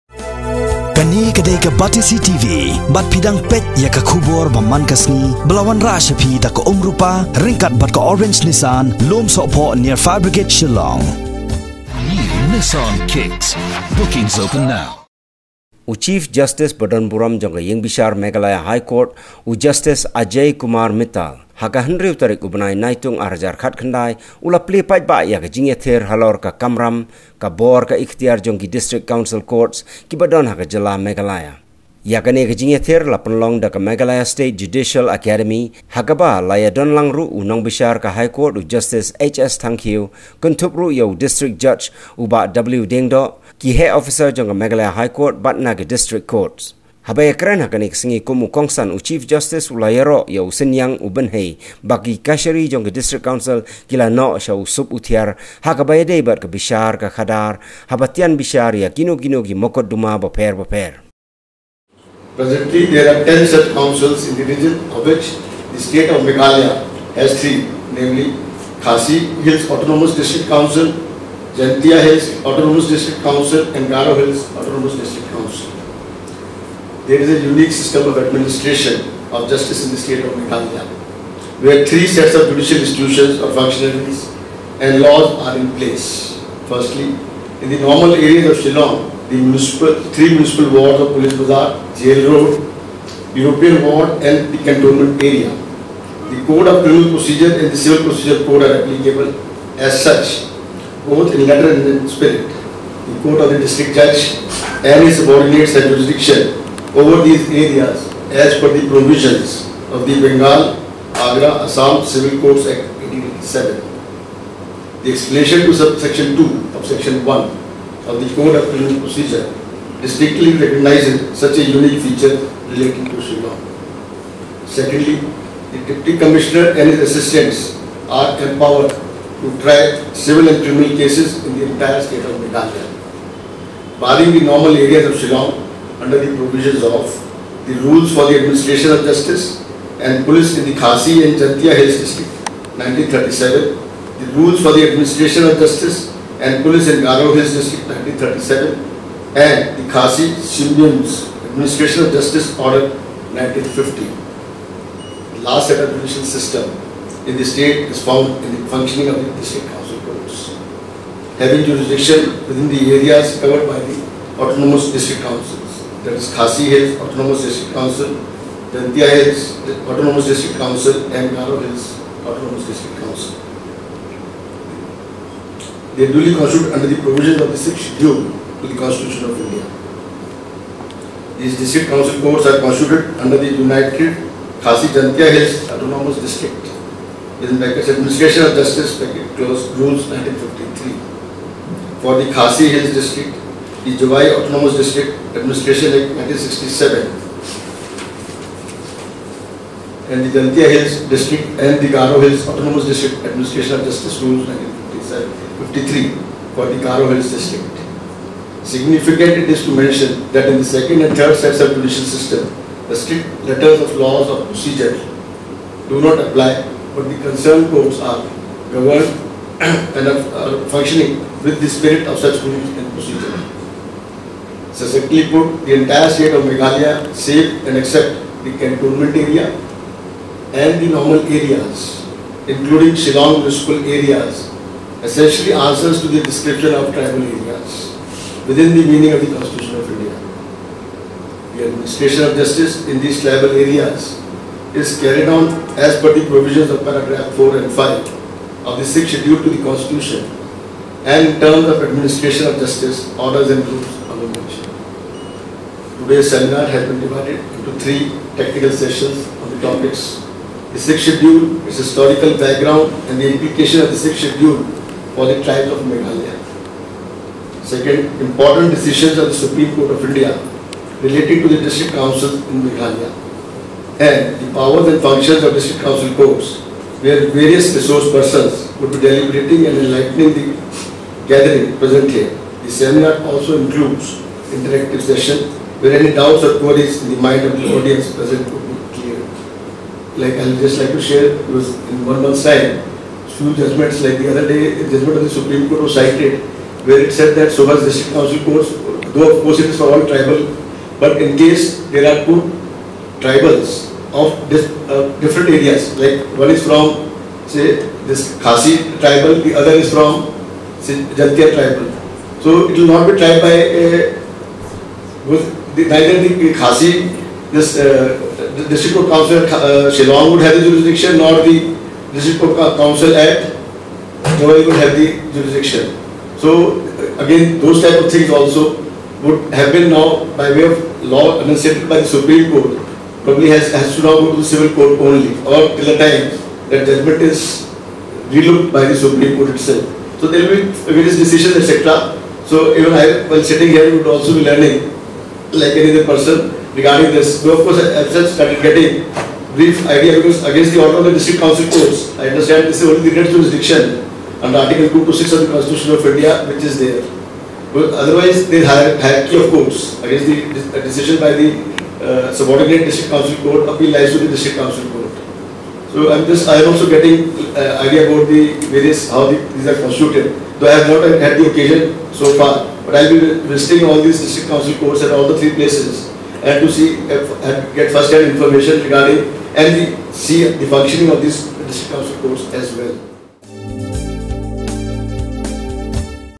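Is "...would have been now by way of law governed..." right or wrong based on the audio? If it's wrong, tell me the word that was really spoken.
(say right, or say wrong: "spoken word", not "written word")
wrong: "enunciated", not "governed".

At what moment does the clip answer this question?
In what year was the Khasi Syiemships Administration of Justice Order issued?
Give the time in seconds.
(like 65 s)
153 s.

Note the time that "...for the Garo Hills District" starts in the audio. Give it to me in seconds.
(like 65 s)
206 s.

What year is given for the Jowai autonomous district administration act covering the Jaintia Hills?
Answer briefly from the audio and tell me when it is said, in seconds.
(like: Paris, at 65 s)
1967, at 196 s.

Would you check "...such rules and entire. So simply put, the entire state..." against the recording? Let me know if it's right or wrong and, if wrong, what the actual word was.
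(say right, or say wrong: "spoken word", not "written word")
wrong: "procedure", not "entire".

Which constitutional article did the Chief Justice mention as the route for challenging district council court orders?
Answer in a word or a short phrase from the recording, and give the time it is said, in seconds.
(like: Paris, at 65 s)
Article 226, at 354 s.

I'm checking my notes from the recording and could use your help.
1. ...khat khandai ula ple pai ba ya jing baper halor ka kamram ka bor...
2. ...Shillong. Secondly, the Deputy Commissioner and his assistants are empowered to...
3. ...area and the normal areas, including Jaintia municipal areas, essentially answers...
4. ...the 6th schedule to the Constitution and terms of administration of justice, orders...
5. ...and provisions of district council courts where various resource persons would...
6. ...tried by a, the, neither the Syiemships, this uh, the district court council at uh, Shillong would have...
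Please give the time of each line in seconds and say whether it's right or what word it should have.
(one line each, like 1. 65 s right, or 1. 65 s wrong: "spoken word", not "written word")
1. 23 s wrong: "ether", not "baper"
2. 123 s right
3. 229 s wrong: "Shillong", not "Jaintia"
4. 248 s right
5. 274 s wrong: "functions", not "provisions"
6. 313 s wrong: "Khasi", not "Syiemships".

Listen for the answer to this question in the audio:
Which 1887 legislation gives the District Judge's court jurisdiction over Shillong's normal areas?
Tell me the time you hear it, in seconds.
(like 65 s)
110 s.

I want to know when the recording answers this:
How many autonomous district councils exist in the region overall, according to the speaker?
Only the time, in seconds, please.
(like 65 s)
63 s.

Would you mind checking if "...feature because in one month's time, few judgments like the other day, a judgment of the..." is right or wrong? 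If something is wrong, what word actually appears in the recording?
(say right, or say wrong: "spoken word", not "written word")
wrong: "share", not "feature".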